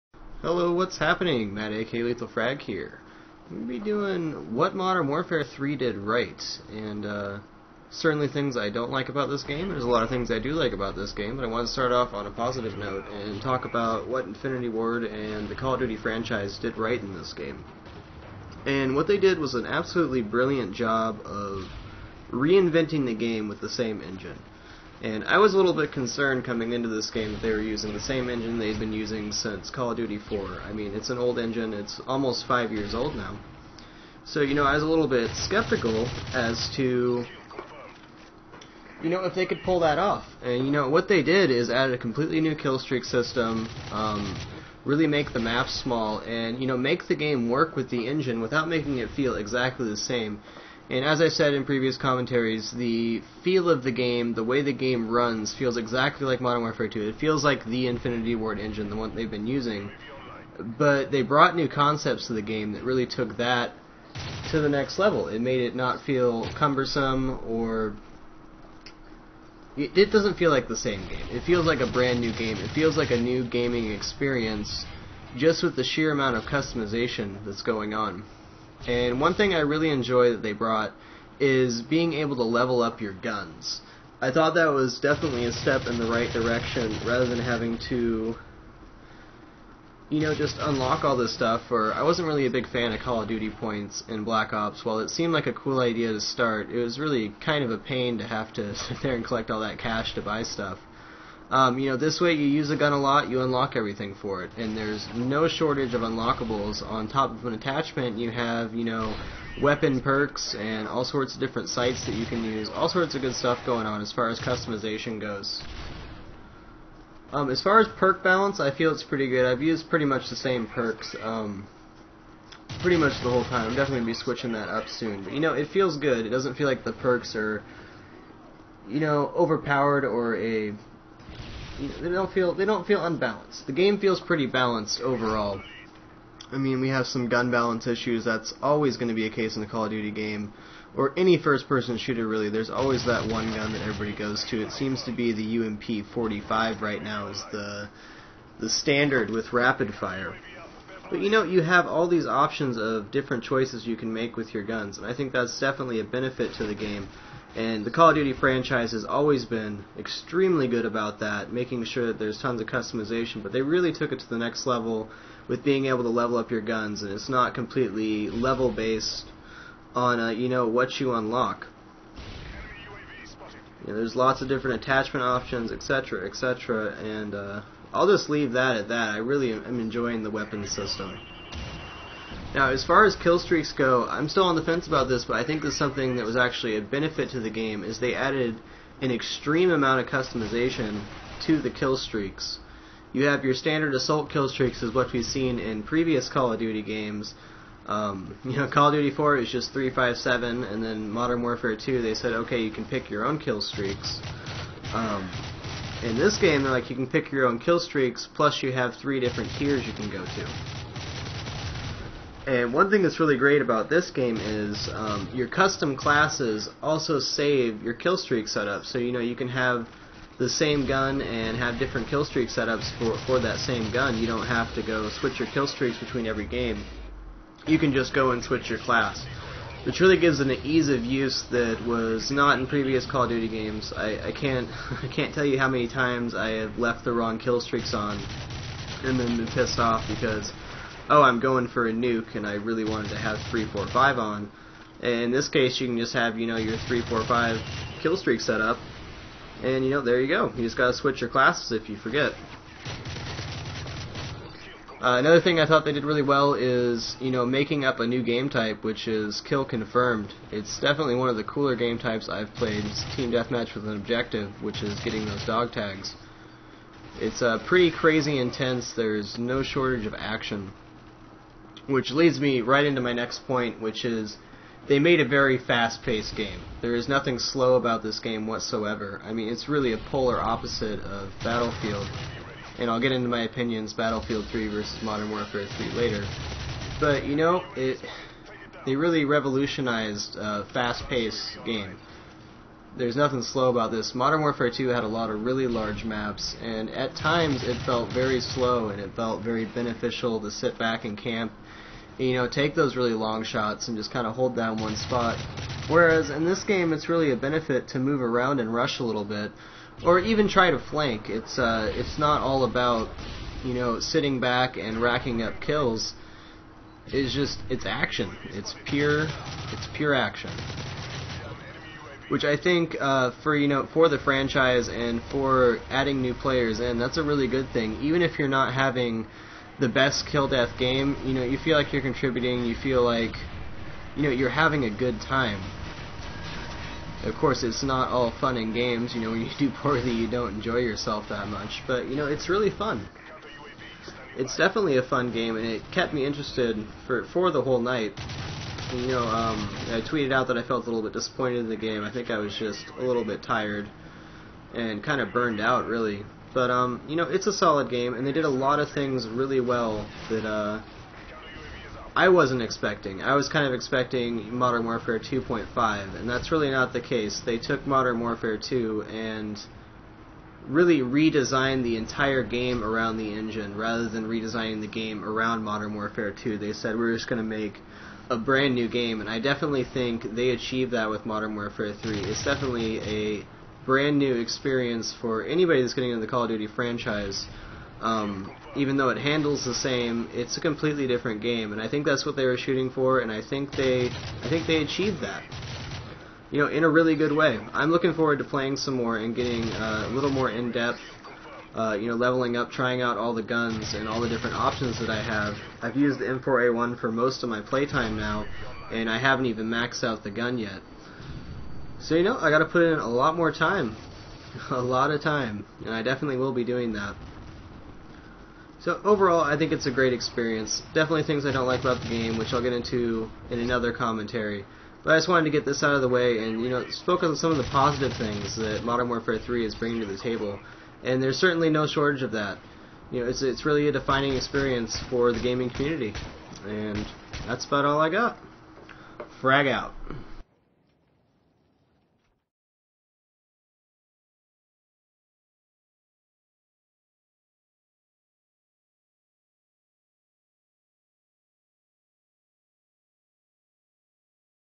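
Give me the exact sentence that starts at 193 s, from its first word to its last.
You have your standard assault kill streaks, is what we've seen in previous Call of Duty games.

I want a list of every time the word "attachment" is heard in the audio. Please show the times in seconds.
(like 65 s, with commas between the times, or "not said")
107 s, 174 s.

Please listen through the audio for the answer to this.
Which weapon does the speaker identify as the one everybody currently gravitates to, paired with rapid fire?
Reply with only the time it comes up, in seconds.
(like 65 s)
145 s.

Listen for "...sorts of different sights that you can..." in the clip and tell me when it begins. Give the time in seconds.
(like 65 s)
111 s.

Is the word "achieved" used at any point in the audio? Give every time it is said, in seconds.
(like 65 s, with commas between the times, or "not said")
380 s, 394 s.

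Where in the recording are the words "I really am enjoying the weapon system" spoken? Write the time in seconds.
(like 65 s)
179 s.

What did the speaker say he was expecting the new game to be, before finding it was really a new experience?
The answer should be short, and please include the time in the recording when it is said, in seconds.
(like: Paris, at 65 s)
Modern Warfare 2.5, at 364 s.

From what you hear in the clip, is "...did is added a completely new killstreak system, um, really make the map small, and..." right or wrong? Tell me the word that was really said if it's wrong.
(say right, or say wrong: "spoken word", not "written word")
right.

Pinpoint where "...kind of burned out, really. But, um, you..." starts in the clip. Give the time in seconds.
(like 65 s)
355 s.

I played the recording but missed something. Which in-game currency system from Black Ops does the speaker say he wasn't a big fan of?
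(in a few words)
Call of Duty points.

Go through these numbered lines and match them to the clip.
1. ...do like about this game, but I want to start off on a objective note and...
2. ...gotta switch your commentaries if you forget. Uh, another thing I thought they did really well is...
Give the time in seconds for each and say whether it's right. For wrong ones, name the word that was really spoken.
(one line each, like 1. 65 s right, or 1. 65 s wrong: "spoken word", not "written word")
1. 10 s wrong: "positive", not "objective"
2. 250 s wrong: "classes", not "commentaries".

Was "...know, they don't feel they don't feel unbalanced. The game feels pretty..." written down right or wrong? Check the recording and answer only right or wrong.
right.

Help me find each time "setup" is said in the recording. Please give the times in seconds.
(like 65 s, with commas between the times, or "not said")
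218 s, 222 s.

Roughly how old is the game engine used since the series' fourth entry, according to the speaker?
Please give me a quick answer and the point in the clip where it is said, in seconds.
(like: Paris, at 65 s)
almost 5 years, at 32 s.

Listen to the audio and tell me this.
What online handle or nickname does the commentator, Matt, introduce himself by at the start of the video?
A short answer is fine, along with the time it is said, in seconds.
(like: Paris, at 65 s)
Lethal Frag, at 2 s.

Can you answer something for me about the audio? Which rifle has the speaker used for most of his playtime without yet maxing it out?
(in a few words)
M4A1.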